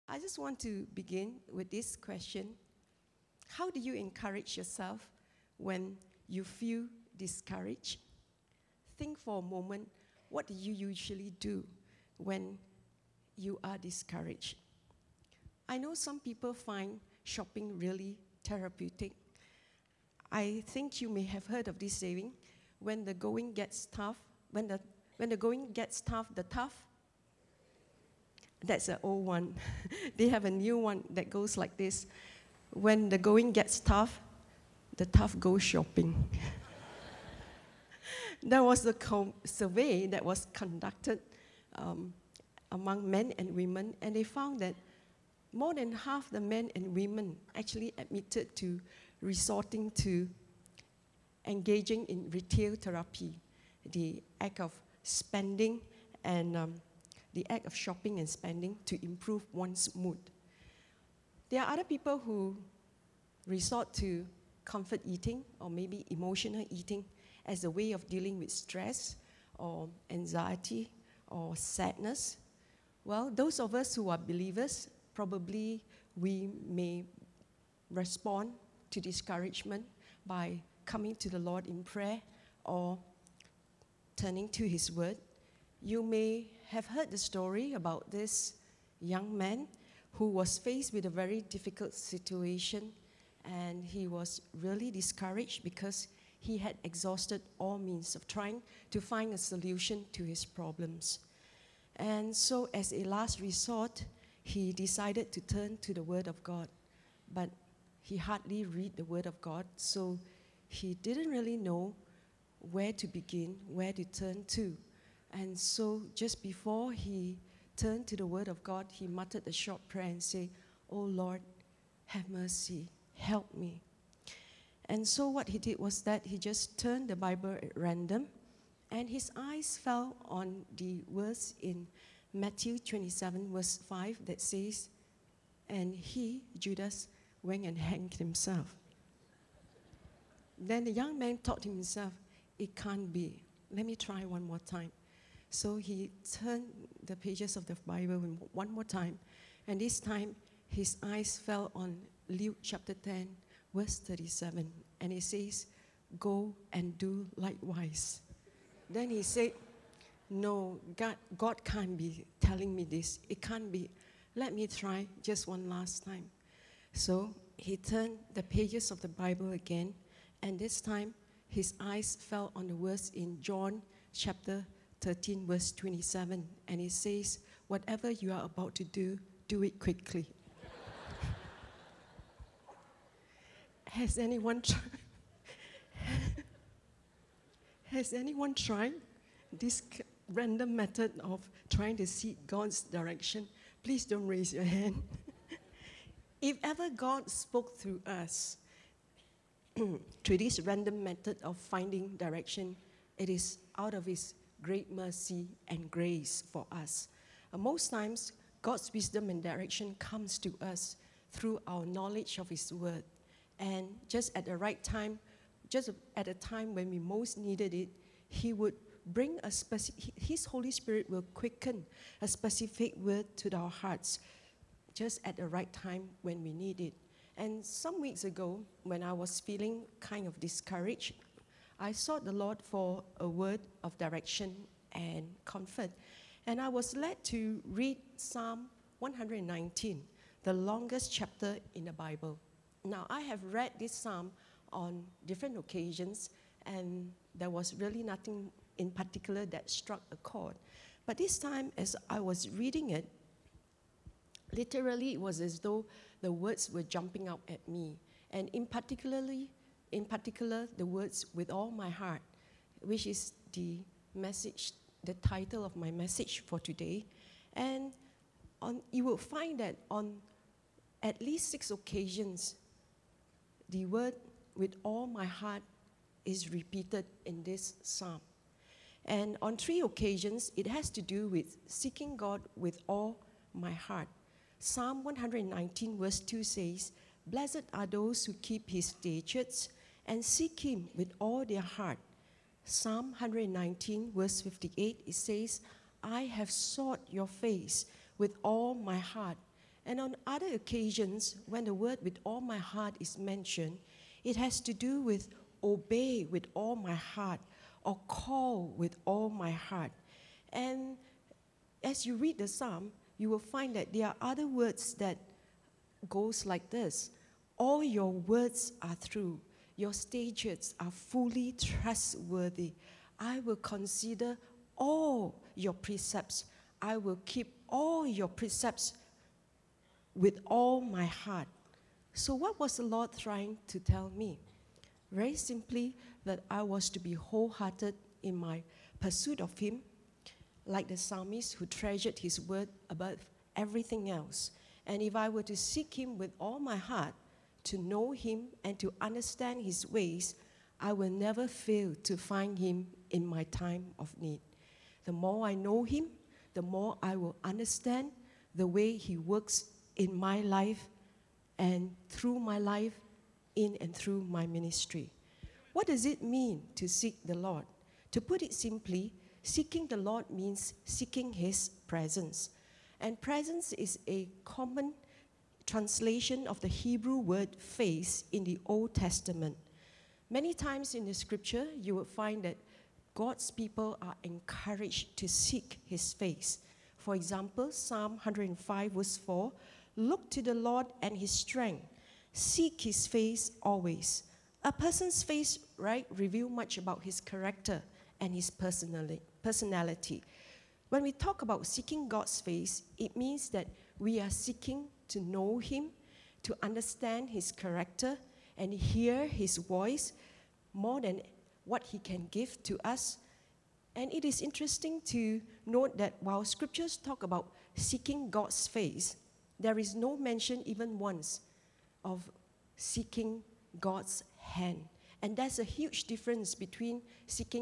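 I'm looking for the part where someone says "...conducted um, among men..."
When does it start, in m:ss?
0:40.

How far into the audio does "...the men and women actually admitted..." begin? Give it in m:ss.
0:46.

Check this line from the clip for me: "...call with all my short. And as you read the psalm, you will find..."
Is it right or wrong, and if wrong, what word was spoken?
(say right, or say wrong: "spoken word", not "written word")
wrong: "heart", not "short".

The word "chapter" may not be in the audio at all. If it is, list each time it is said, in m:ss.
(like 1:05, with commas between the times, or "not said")
2:32, 2:54, 4:01.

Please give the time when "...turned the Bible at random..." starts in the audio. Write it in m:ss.
2:06.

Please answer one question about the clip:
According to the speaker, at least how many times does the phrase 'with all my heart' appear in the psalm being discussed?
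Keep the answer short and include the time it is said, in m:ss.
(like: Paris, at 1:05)
6, at 4:31.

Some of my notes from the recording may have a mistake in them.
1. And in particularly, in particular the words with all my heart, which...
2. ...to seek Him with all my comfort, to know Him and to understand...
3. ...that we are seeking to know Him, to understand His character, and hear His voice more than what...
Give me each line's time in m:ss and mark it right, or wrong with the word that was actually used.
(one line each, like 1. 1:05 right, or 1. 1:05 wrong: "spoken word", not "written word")
1. 4:18 right
2. 5:45 wrong: "heart", not "comfort"
3. 6:43 right.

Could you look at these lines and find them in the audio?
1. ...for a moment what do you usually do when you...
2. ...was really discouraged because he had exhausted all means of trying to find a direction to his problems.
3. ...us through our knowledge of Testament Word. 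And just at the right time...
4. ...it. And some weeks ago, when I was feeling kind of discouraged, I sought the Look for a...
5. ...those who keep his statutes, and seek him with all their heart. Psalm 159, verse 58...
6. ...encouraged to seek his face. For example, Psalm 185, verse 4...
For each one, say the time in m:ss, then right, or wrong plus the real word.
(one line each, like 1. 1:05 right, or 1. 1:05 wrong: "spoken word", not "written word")
1. 0:09 right
2. 1:34 wrong: "solution", not "direction"
3. 3:30 wrong: "His", not "Testament"
4. 3:46 wrong: "Lord", not "Look"
5. 4:47 wrong: "119", not "159"
6. 6:24 wrong: "105", not "185".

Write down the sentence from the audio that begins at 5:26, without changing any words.
I will keep all your precepts with all my heart.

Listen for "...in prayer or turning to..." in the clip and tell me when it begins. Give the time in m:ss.
1:21.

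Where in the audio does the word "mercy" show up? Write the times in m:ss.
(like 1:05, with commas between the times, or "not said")
2:02, 3:24.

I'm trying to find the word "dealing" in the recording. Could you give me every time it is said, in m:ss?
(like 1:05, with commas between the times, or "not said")
1:08.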